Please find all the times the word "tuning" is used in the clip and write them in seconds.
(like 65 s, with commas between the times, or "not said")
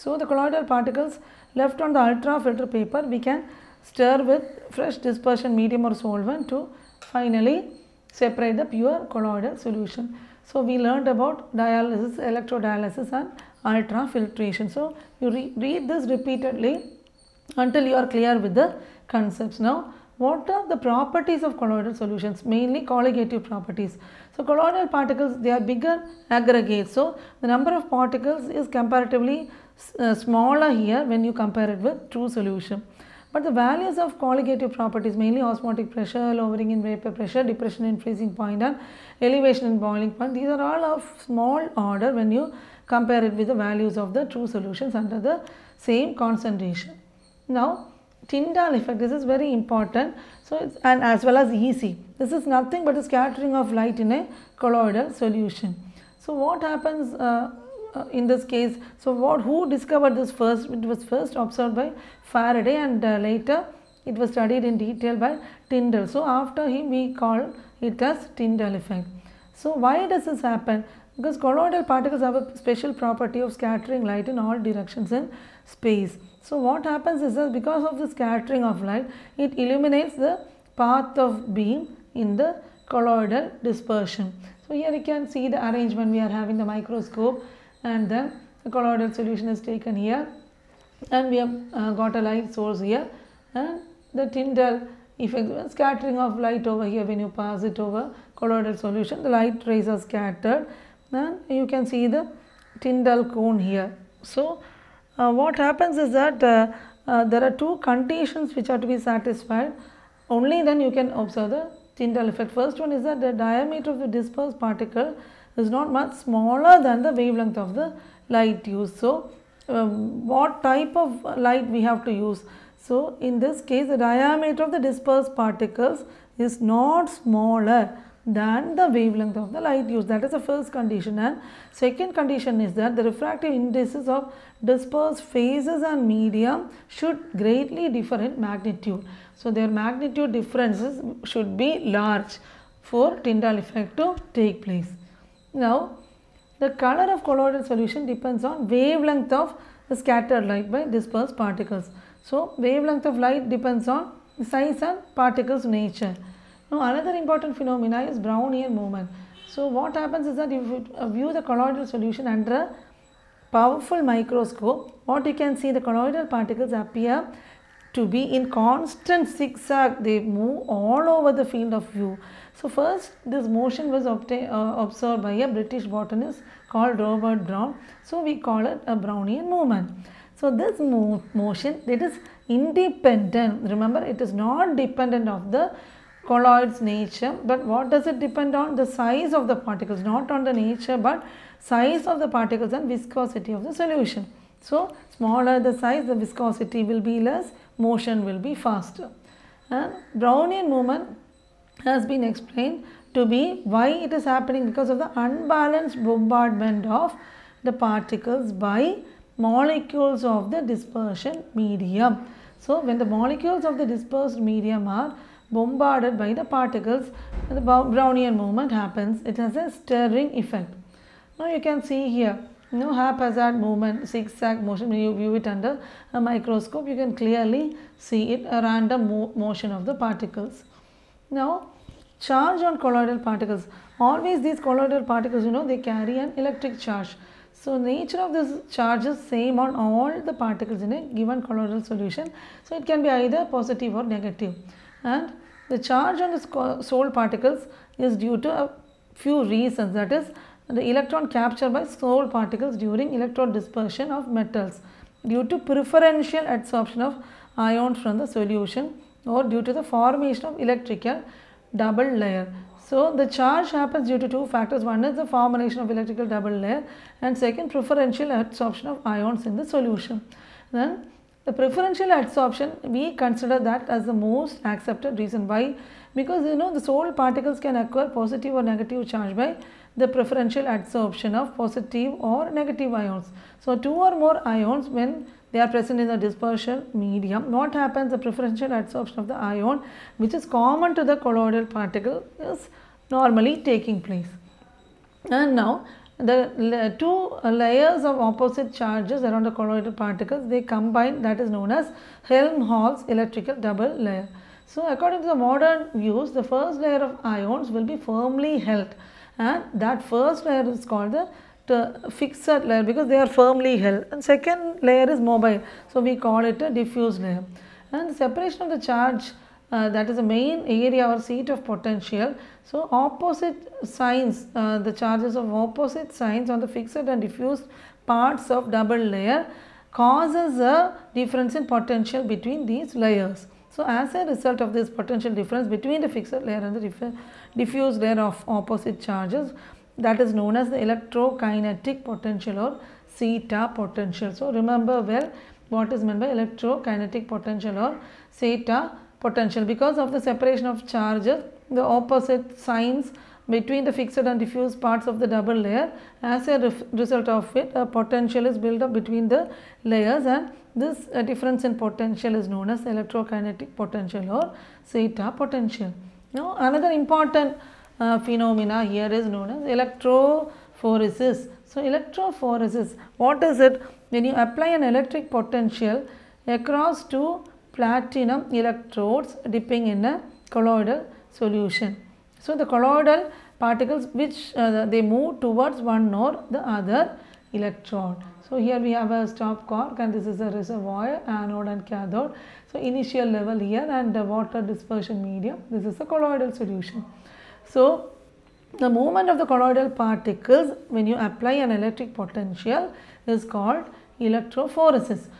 not said.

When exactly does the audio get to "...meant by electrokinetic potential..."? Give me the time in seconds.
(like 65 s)
346 s.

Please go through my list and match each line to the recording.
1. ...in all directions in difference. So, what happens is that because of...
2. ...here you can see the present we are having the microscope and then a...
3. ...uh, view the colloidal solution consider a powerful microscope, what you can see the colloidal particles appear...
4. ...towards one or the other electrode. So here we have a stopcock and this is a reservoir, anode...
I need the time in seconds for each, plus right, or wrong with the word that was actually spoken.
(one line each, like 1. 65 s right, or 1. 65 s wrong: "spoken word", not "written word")
1. 74 s wrong: "space", not "difference"
2. 84 s wrong: "arrangement", not "present"
3. 160 s wrong: "under", not "consider"
4. 385 s right.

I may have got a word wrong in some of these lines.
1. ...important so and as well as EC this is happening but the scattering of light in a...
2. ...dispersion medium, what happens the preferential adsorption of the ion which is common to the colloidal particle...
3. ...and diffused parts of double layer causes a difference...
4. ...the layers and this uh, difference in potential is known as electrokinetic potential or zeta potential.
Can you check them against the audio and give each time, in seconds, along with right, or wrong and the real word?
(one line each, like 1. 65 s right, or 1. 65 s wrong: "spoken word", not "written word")
1. 49 s wrong: "nothing", not "happening"
2. 286 s right
3. 326 s right
4. 359 s right.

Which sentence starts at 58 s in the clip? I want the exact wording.
So, what who discovered this first?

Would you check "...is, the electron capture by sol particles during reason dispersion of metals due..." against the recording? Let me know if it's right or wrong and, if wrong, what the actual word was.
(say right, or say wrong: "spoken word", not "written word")
wrong: "electron", not "reason".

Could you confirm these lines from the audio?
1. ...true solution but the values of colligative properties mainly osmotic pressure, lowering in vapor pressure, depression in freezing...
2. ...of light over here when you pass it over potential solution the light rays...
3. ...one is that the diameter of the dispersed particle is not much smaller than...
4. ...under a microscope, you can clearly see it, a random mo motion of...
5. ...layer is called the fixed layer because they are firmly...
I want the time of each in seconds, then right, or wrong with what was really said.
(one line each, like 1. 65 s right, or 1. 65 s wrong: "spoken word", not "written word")
1. 32 s right
2. 96 s wrong: "colloidal", not "potential"
3. 112 s right
4. 225 s right
5. 310 s right.